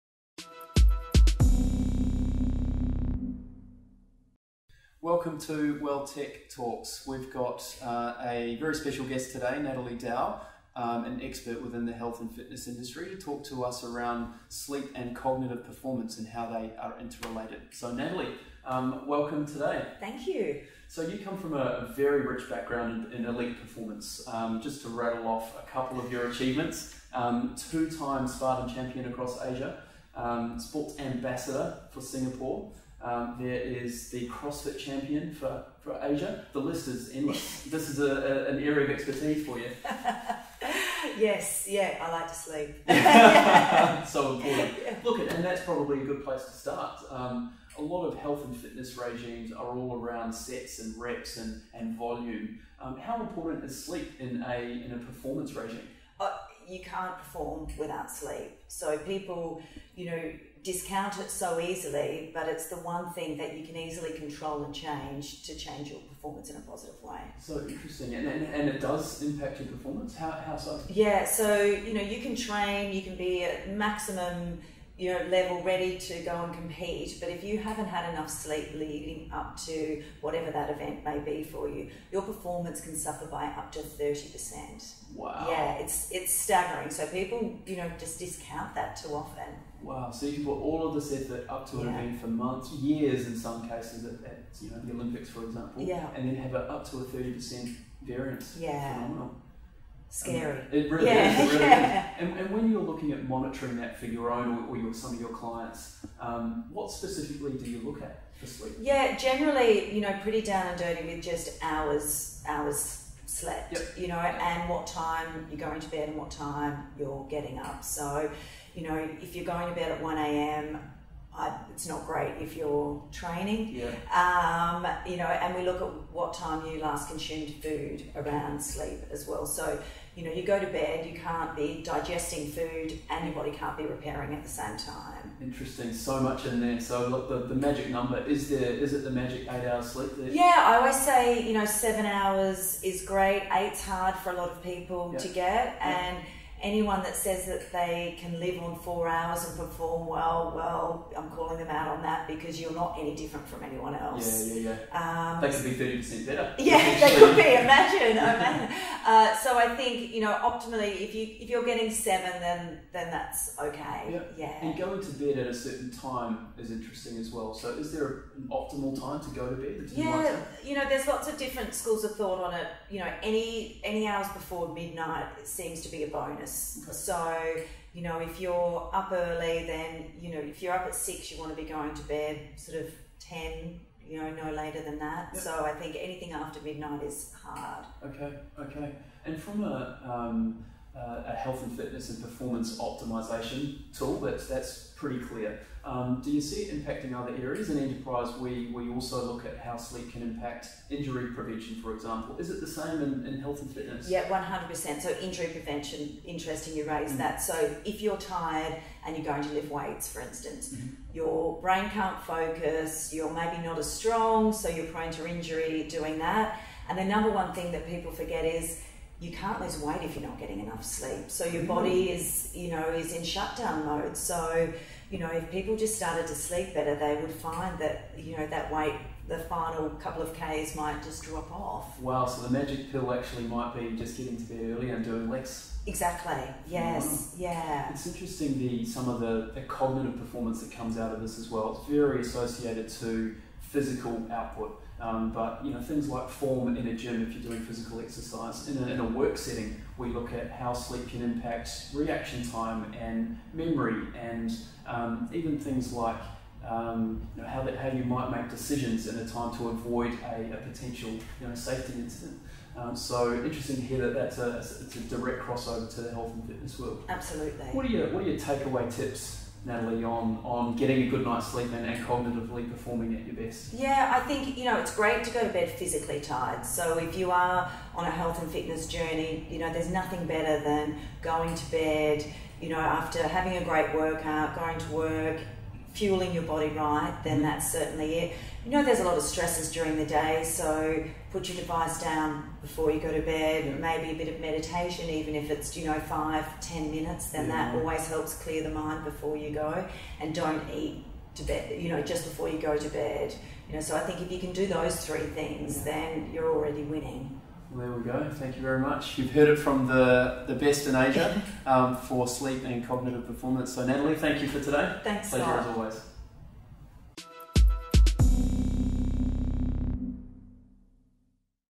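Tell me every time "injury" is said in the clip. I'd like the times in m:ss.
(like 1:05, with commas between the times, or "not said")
3:20, 3:25, 3:35.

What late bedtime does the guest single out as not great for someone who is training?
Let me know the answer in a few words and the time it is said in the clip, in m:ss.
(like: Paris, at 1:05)
1 a.m., at 2:00.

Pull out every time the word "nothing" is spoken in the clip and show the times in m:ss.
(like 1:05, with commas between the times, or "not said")
4:39.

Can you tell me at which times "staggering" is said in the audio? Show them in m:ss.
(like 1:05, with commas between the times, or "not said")
1:26.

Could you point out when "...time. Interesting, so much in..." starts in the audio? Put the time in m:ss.
2:14.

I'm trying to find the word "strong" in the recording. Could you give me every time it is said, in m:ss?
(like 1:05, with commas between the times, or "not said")
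3:33.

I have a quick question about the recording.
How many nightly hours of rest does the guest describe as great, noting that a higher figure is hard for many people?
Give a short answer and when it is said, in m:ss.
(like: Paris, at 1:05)
7 hours, at 2:21.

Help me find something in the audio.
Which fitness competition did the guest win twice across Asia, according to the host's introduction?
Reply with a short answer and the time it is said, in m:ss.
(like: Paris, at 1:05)
Spartan, at 0:28.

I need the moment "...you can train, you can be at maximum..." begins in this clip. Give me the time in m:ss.
1:12.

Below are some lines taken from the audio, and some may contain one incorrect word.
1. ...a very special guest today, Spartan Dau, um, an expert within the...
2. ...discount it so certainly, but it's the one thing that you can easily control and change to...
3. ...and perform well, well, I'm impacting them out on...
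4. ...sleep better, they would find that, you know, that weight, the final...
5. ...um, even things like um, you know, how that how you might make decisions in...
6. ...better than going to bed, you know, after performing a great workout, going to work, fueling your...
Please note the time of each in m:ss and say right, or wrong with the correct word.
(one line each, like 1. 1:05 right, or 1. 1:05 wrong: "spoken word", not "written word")
1. 0:08 wrong: "Natalie", not "Spartan"
2. 1:00 wrong: "easily", not "certainly"
3. 2:29 wrong: "calling", not "impacting"
4. 3:46 right
5. 4:14 right
6. 4:40 wrong: "having", not "performing".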